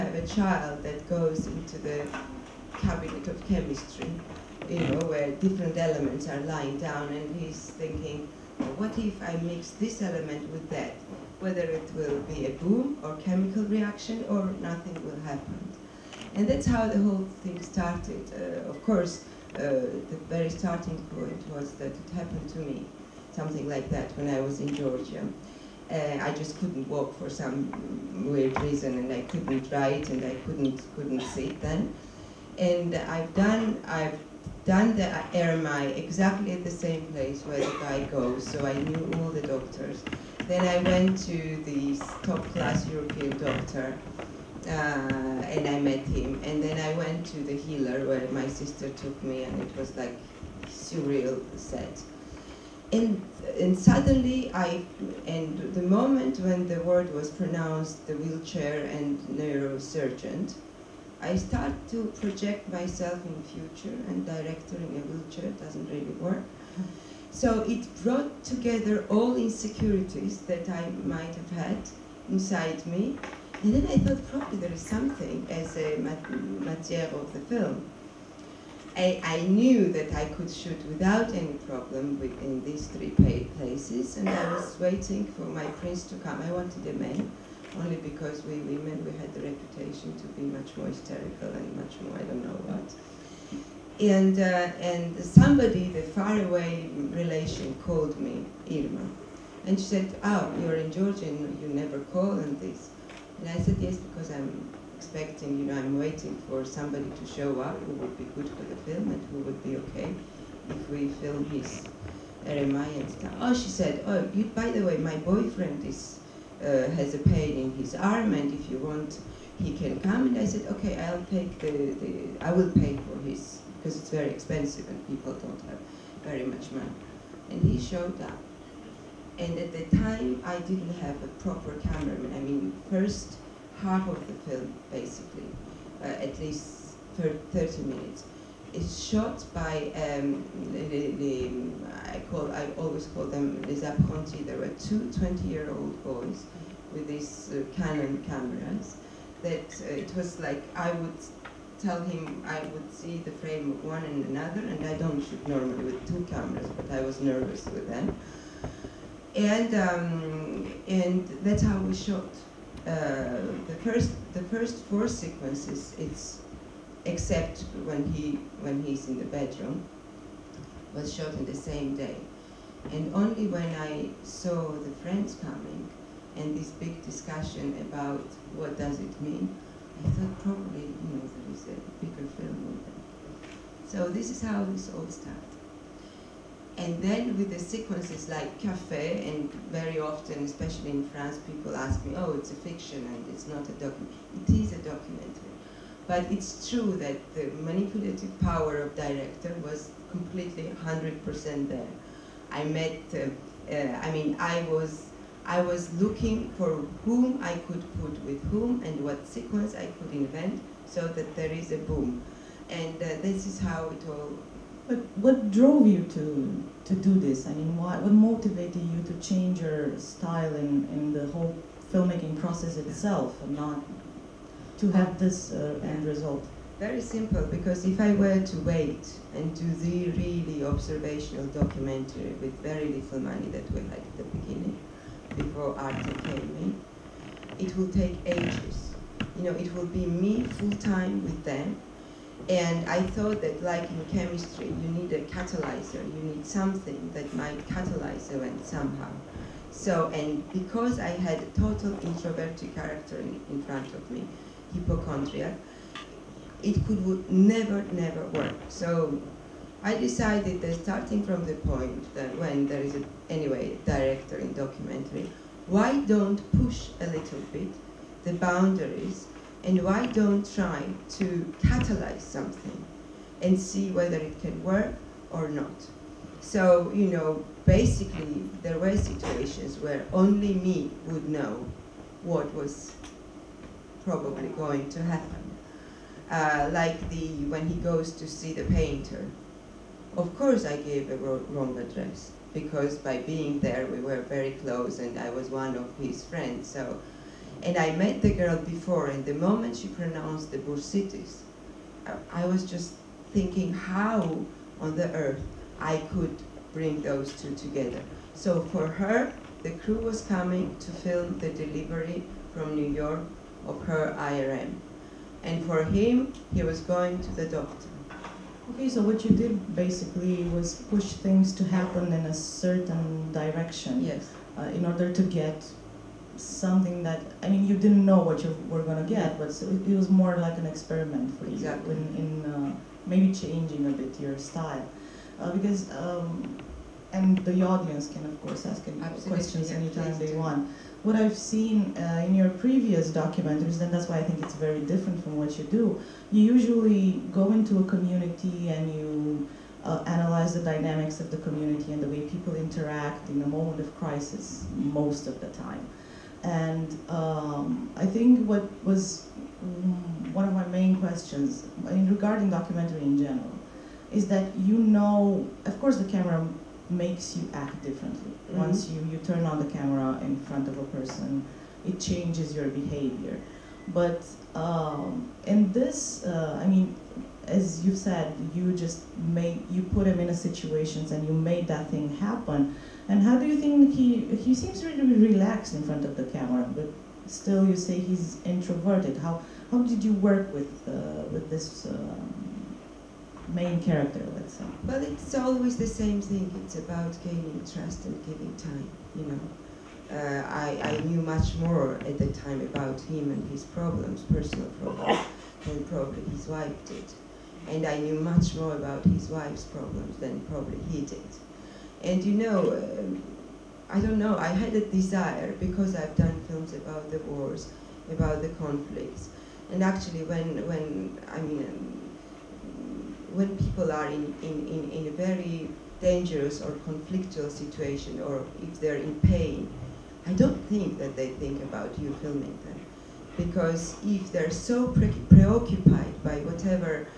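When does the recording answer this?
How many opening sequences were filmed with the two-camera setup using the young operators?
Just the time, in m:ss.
2:44.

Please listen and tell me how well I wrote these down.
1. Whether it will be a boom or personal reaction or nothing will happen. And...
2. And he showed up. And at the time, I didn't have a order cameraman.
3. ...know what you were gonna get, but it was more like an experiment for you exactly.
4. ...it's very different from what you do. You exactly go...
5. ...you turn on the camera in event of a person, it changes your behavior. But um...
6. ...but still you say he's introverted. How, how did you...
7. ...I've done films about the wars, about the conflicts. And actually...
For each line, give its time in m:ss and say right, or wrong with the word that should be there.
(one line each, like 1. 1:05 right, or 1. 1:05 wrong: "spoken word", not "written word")
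1. 0:11 wrong: "chemical", not "personal"
2. 2:07 wrong: "proper", not "order"
3. 5:28 right
4. 5:44 wrong: "usually", not "exactly"
5. 6:09 wrong: "front", not "event"
6. 6:26 right
7. 6:55 right.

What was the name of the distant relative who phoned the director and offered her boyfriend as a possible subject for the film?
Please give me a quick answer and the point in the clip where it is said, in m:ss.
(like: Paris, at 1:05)
Irma, at 1:38.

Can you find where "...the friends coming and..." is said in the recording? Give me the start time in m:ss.
2:54.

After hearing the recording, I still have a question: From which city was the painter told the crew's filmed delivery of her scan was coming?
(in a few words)
New York.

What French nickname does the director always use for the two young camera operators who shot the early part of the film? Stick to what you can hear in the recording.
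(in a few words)
les apprentis.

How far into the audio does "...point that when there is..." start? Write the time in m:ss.
4:21.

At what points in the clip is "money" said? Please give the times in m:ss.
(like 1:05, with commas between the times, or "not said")
2:06, 3:53.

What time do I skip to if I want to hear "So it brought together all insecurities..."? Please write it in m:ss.
1:07.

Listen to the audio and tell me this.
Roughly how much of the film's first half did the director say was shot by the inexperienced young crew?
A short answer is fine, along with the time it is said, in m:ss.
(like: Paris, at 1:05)
30 minutes, at 2:17.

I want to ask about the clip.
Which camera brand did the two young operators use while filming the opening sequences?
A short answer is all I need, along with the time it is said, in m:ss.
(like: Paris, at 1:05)
Canon, at 2:27.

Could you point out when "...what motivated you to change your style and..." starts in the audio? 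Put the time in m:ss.
3:37.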